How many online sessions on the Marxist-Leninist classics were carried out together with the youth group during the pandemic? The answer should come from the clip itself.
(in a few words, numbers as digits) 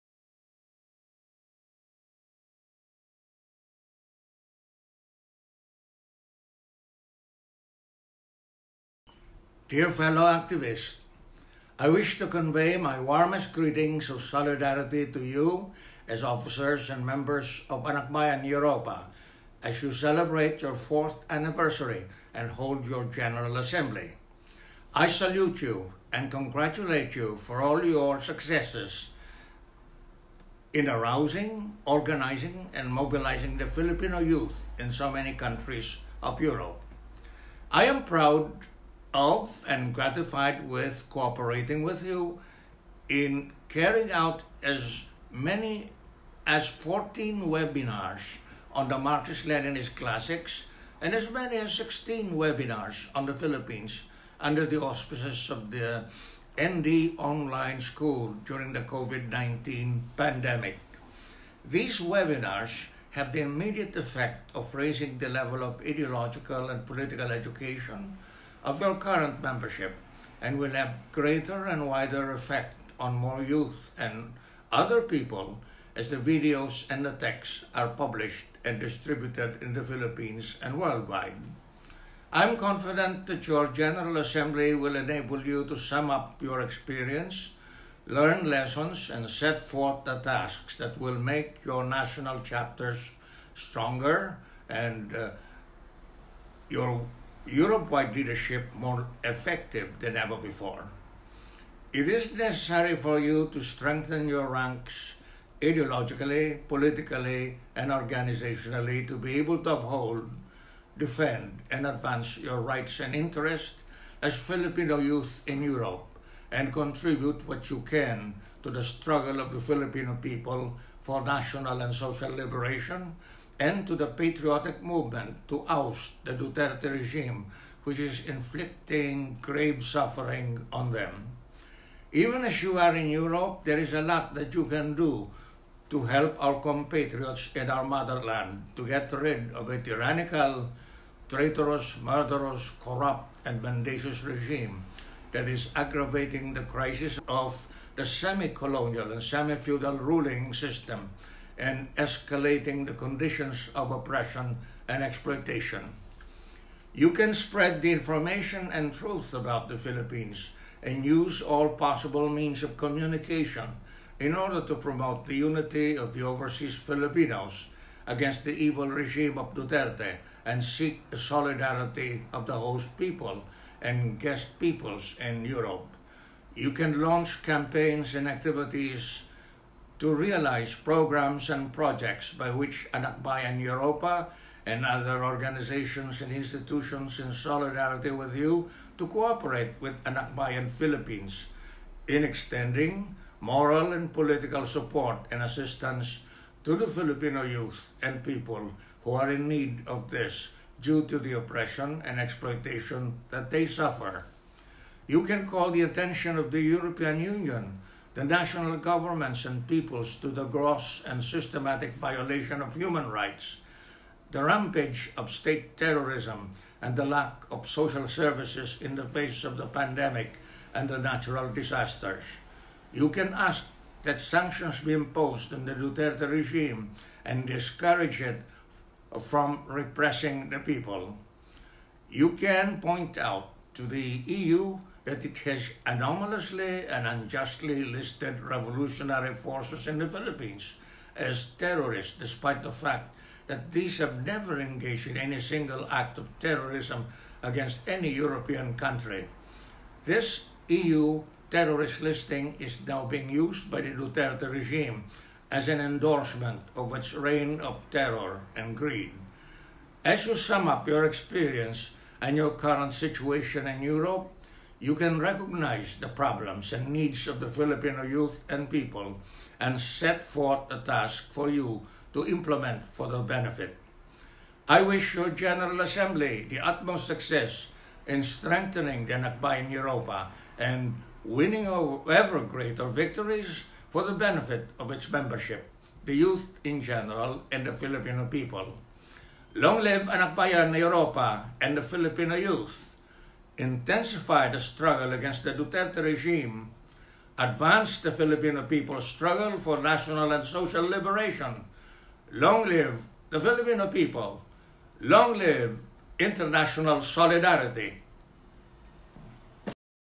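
14.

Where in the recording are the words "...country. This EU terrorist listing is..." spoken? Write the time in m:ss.
4:08.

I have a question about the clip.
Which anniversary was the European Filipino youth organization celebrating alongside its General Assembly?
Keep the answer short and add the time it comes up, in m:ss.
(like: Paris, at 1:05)
fourth, at 0:20.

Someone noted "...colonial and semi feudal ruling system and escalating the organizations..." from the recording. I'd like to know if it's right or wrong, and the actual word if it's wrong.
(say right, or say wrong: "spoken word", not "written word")
wrong: "conditions", not "organizations".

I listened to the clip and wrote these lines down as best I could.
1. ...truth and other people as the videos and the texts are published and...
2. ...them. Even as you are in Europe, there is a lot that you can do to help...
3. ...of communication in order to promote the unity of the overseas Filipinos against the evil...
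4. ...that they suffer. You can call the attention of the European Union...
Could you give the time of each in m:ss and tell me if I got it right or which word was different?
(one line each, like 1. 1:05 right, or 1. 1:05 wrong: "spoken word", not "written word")
1. 1:13 wrong: "youth", not "truth"
2. 2:10 right
3. 2:42 right
4. 3:23 right.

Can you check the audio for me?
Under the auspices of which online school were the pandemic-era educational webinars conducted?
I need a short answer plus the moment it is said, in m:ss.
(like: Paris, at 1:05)
ND Online School, at 0:56.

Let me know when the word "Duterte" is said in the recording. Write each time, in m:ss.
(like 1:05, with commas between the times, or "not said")
2:06, 2:49, 3:45, 4:13, 4:55.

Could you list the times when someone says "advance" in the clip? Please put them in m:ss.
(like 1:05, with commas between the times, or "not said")
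1:51, 4:57.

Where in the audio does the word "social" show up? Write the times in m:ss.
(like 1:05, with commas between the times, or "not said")
2:01, 3:37, 5:00.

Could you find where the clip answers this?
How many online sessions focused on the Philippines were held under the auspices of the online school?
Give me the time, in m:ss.
0:51.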